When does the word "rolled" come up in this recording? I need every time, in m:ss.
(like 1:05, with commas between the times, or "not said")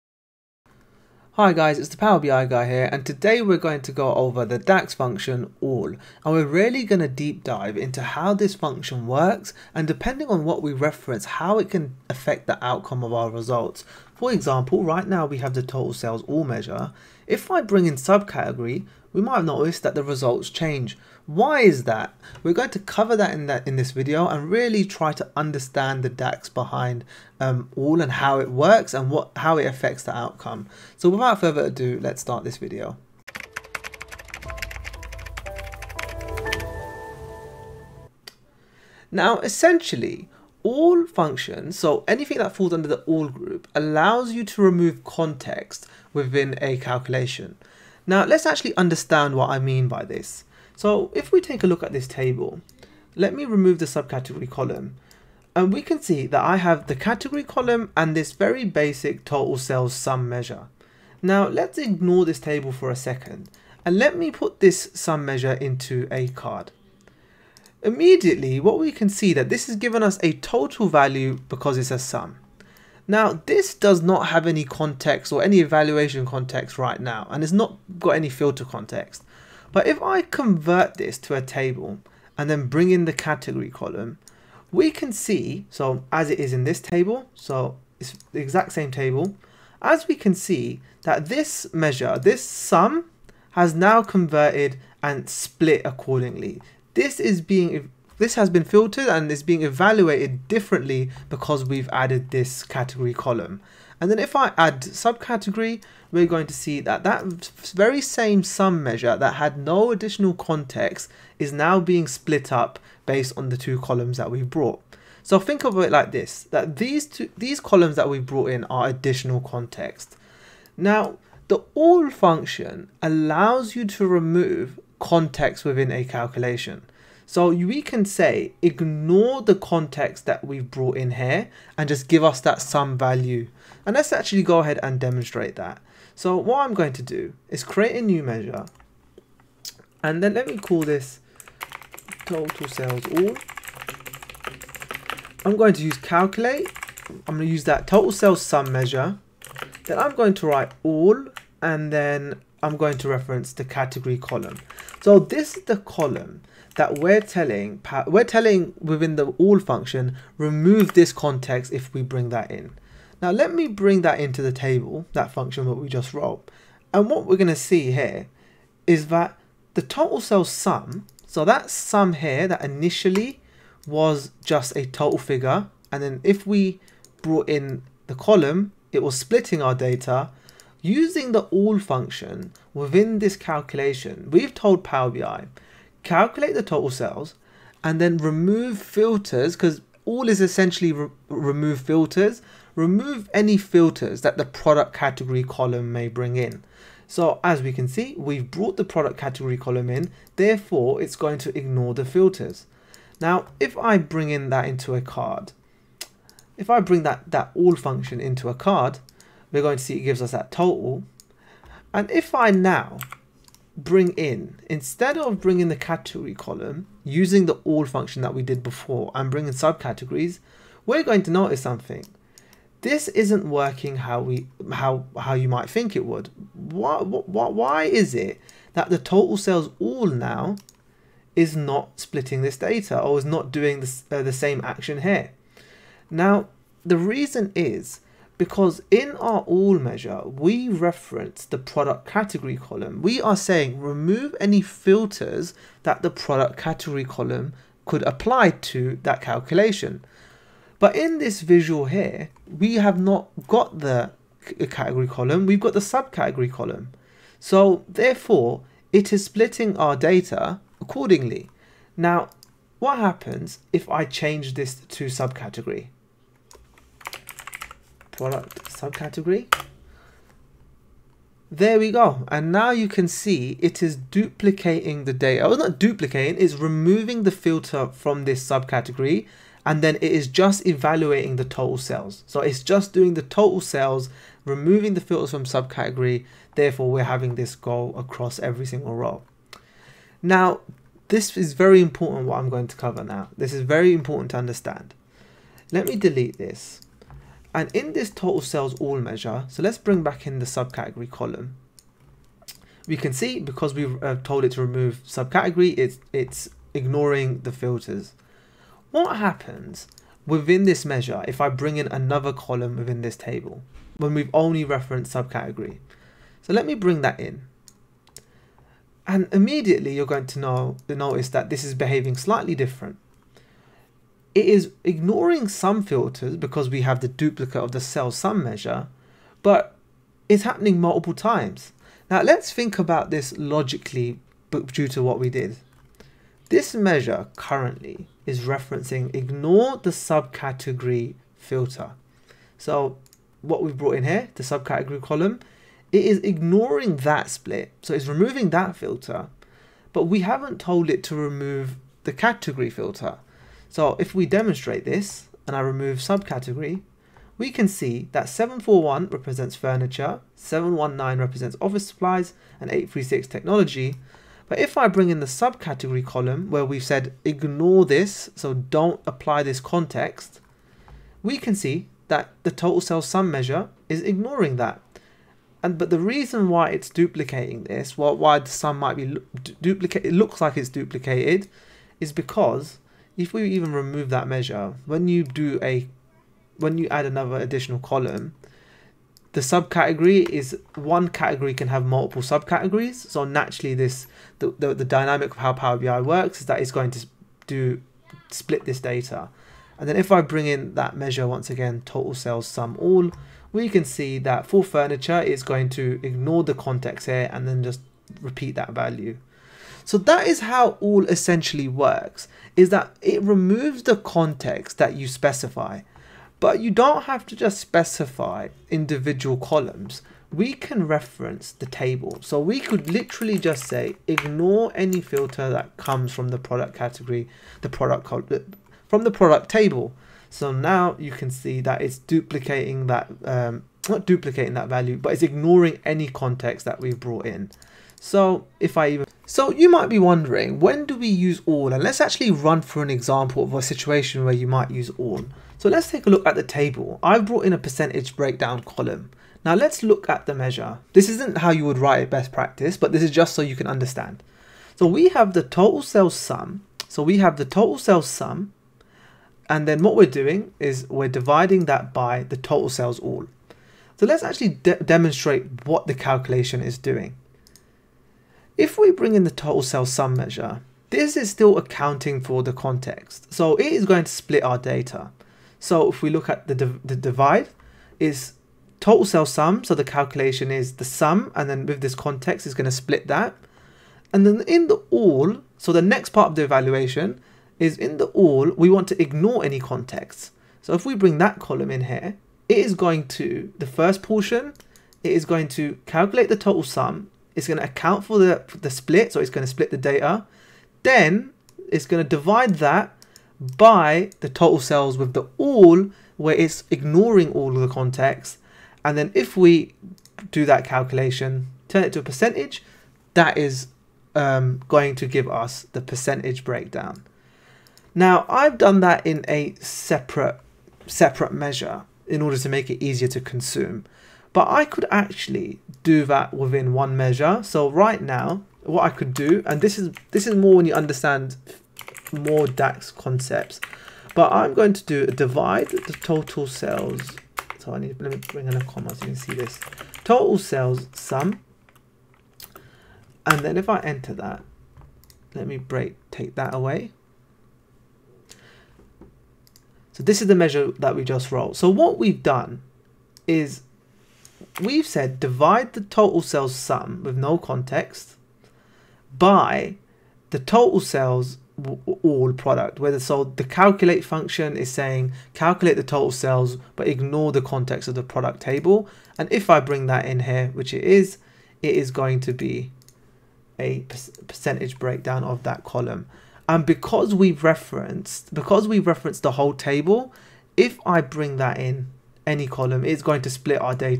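9:11.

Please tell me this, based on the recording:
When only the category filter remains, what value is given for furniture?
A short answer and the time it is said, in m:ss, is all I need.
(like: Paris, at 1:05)
741, at 5:58.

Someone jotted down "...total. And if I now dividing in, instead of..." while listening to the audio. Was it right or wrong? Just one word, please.
wrong.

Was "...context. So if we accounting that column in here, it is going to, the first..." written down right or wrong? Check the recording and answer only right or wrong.
wrong.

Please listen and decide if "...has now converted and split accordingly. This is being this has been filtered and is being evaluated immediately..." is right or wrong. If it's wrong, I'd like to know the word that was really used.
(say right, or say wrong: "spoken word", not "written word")
wrong: "differently", not "immediately".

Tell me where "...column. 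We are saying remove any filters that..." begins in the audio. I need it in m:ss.
4:02.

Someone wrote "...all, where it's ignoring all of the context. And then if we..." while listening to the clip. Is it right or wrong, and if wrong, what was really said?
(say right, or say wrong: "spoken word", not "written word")
right.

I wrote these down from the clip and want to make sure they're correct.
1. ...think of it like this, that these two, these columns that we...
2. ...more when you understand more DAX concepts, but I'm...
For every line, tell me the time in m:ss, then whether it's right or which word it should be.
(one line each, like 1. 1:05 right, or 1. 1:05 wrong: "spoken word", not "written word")
1. 1:55 right
2. 8:50 right.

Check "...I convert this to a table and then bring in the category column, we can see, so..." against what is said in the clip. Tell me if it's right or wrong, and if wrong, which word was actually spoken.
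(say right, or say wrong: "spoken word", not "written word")
right.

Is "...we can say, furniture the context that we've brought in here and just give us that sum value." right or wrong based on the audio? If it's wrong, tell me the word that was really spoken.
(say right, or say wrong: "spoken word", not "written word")
wrong: "ignore", not "furniture".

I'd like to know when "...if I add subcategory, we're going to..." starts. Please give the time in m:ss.
1:44.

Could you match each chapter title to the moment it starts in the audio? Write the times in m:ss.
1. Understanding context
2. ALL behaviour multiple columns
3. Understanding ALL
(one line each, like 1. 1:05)
1. 0:40
2. 5:09
3. 2:25.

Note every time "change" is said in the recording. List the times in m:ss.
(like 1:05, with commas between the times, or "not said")
0:20, 4:24.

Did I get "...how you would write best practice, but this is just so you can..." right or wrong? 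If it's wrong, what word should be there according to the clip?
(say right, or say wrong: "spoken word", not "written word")
right.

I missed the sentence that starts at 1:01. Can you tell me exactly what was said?
Now let's ignore this table for a second and let me put this sum measure into a card.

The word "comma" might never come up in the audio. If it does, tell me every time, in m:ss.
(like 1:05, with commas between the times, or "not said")
8:58.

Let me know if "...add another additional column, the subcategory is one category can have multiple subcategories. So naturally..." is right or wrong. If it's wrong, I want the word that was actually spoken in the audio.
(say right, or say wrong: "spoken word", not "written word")
right.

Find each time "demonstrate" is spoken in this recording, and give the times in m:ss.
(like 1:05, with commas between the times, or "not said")
2:14, 5:54, 7:44.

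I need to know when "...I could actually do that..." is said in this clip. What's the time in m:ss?
8:44.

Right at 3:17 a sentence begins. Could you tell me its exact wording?
So as we can see, we've brought the product category column in, therefore it's going to ignore the filters.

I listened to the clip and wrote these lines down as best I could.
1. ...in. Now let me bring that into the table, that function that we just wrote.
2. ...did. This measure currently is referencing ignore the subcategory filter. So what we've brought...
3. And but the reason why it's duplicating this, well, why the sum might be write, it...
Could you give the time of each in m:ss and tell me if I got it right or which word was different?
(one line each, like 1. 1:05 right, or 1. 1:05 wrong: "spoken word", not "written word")
1. 2:42 right
2. 5:35 right
3. 6:15 wrong: "duplicate", not "write".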